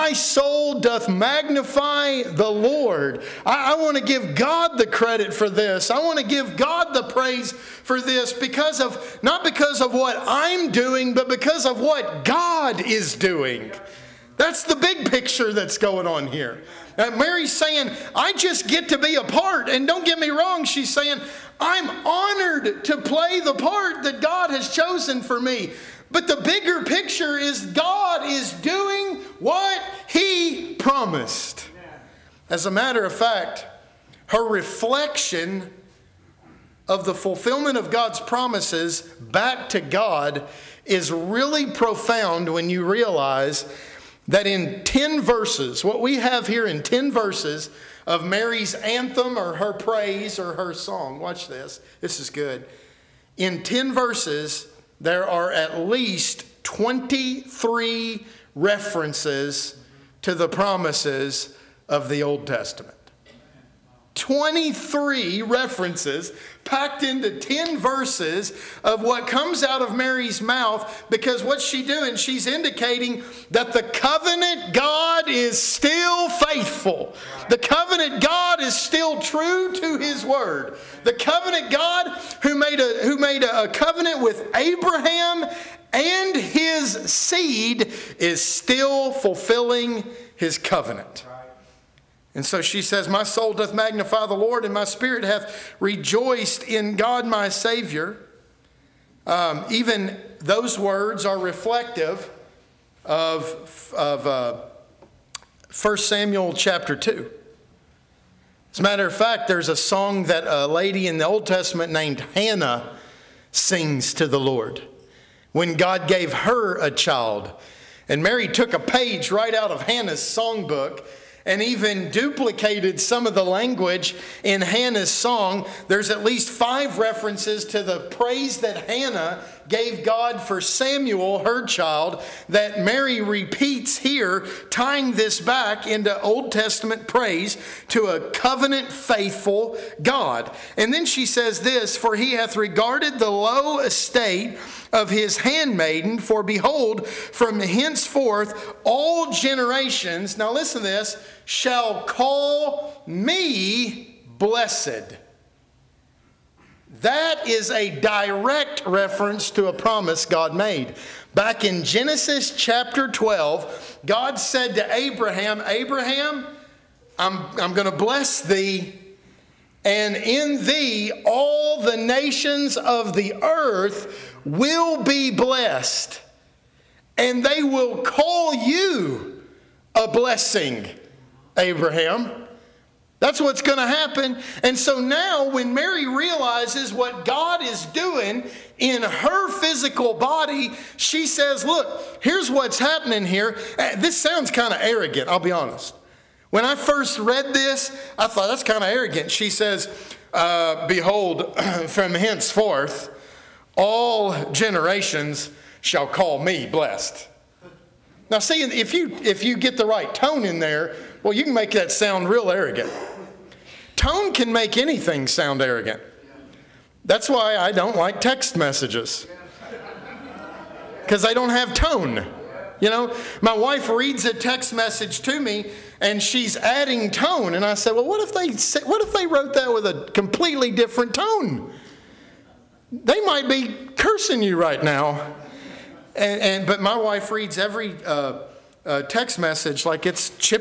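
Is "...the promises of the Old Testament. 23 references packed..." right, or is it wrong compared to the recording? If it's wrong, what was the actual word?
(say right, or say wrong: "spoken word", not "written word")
right.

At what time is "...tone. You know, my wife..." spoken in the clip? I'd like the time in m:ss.
3:41.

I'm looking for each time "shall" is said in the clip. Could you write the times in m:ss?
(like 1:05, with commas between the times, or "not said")
2:31, 3:25.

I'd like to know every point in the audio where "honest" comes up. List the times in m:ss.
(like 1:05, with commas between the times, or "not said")
3:15.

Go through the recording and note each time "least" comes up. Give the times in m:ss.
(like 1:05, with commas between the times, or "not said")
0:55, 2:06.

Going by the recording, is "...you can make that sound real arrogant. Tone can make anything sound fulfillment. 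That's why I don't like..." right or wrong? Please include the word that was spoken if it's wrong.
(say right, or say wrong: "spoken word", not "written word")
wrong: "arrogant", not "fulfillment".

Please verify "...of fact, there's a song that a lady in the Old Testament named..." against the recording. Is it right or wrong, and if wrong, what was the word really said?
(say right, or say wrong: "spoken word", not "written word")
right.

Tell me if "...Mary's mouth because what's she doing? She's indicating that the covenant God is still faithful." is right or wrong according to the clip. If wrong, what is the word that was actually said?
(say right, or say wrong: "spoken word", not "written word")
right.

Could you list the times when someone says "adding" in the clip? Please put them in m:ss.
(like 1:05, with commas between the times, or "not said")
3:46.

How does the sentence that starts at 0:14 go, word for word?
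That's the big picture that's going on here.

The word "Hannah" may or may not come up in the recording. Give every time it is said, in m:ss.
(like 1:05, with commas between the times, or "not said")
1:52, 1:59, 2:04, 2:08.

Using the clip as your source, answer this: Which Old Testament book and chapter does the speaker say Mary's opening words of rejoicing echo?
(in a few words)
1 Samuel chapter 2.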